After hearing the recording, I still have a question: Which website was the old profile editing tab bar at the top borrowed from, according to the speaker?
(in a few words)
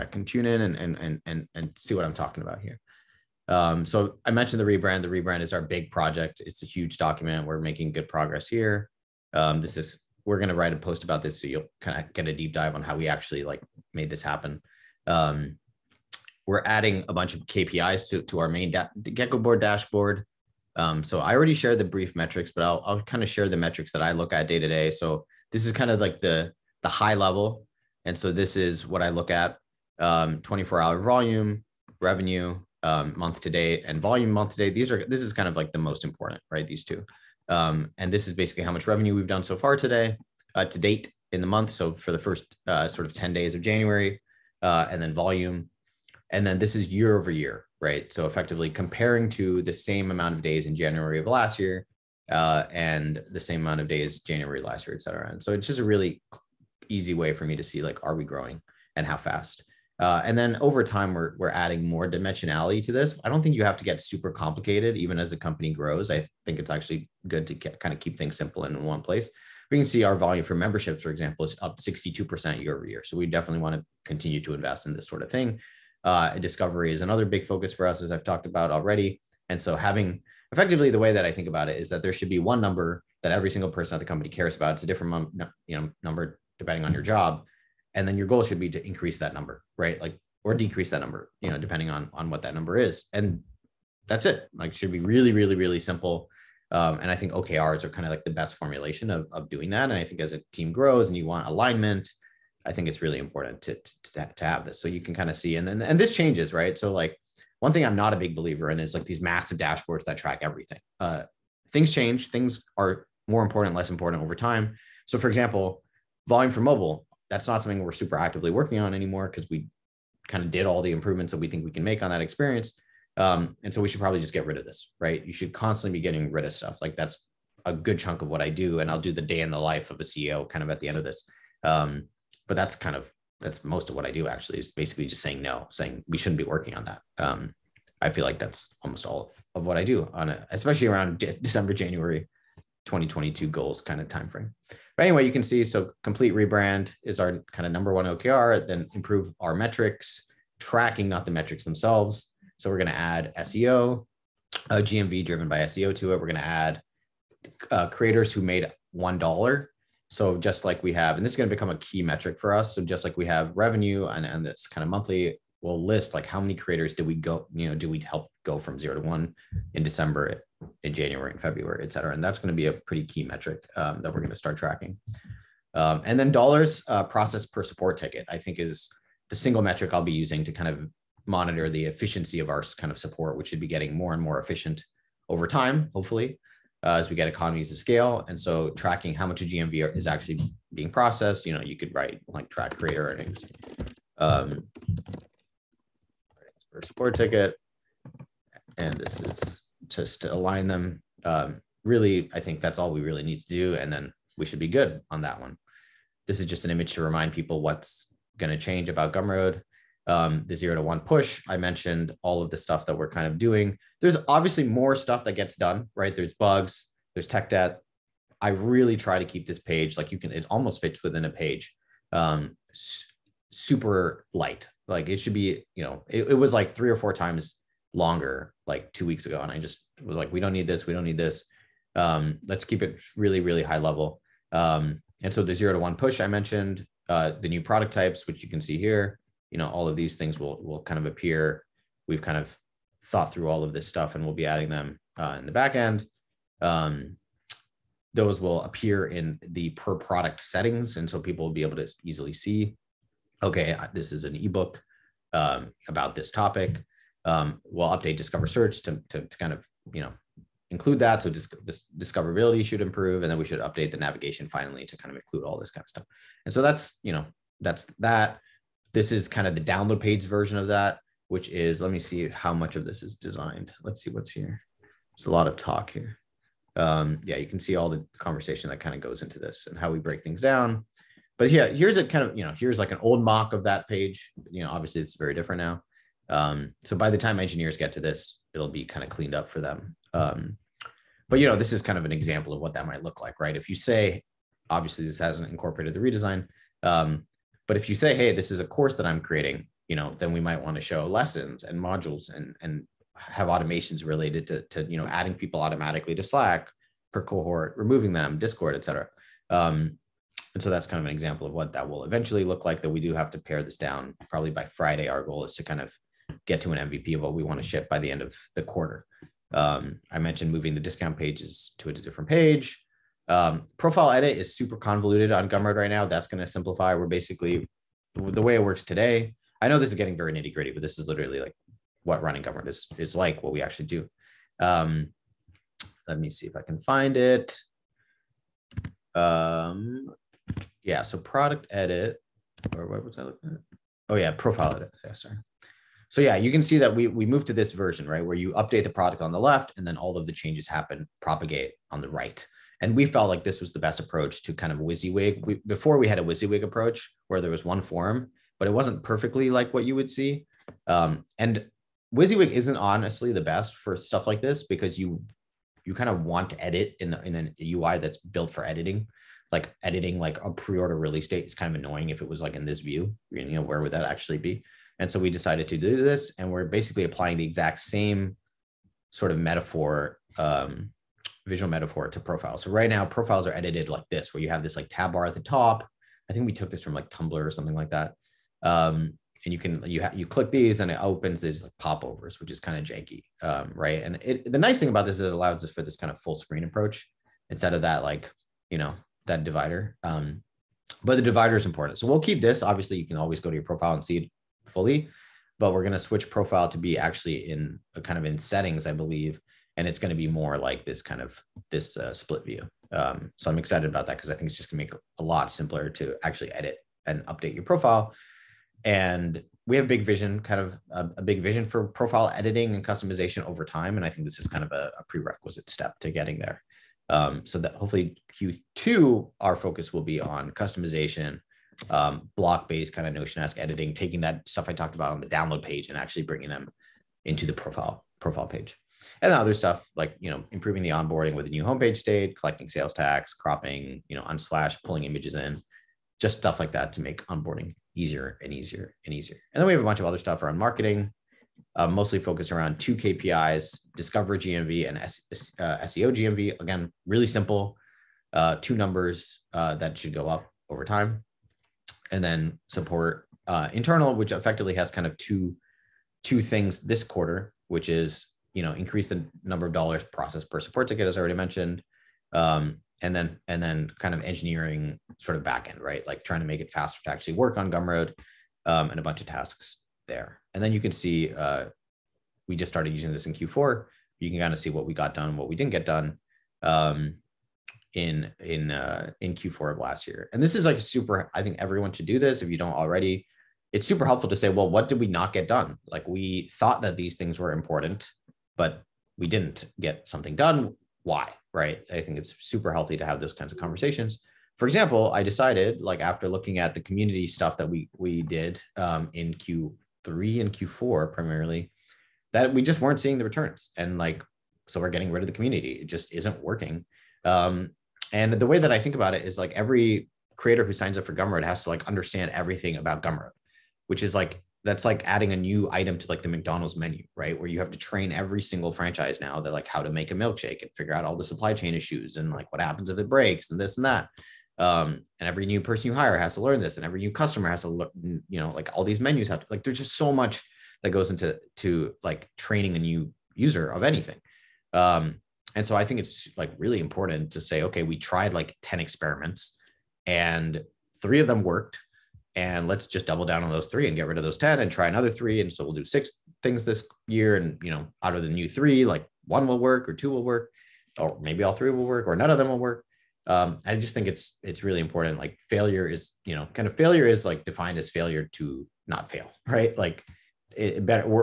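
Tumblr.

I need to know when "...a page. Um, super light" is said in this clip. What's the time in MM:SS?
03:41.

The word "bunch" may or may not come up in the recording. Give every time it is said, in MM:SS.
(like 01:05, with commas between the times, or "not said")
00:17, 07:29, 07:59.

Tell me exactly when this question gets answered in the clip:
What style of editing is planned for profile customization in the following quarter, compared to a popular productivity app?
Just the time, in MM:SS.
07:13.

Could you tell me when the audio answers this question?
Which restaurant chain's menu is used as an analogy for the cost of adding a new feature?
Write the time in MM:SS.
08:46.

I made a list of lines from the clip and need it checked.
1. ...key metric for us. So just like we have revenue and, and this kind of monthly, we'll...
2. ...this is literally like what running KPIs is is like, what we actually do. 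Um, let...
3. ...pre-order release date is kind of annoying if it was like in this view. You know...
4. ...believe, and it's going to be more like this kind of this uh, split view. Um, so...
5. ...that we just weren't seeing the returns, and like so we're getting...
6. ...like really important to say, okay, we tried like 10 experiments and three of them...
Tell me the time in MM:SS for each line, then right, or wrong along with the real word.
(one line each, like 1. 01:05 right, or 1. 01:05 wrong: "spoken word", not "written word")
1. 02:41 right
2. 05:30 wrong: "Gumroad", not "KPIs"
3. 06:10 right
4. 06:48 right
5. 08:32 right
6. 09:06 right.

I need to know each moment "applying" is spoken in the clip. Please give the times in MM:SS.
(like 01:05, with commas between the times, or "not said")
06:17.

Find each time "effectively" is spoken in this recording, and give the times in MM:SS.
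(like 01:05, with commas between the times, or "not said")
00:48, 01:20, 07:44.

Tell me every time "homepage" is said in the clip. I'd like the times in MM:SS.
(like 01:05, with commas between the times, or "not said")
07:21.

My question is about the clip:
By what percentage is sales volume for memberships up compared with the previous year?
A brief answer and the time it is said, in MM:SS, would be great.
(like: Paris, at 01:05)
62%, at 01:11.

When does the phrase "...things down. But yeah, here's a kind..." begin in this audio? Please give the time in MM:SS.
04:40.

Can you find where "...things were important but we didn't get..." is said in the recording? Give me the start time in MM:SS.
08:17.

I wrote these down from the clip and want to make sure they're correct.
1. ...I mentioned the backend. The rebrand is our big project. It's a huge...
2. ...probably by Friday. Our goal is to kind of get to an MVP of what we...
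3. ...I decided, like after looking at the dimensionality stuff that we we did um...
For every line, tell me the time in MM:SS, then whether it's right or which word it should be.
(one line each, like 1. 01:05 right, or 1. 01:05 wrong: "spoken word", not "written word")
1. 00:04 wrong: "rebrand", not "backend"
2. 05:14 right
3. 08:25 wrong: "community", not "dimensionality".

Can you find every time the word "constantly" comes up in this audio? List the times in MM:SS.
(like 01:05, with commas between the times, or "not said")
02:05.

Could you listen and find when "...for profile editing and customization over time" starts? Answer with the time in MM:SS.
07:01.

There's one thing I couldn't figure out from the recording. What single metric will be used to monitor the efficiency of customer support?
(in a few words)
Dollars processed per support ticket.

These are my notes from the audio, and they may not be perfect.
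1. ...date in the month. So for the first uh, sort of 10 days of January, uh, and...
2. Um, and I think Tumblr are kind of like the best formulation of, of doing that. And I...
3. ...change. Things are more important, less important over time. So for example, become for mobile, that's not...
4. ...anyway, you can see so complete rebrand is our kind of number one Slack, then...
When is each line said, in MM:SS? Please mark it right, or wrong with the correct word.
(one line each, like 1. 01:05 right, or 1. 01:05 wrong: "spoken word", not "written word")
1. 00:40 right
2. 01:36 wrong: "OKRs", not "Tumblr"
3. 01:51 wrong: "volume", not "become"
4. 02:25 wrong: "OKR", not "Slack".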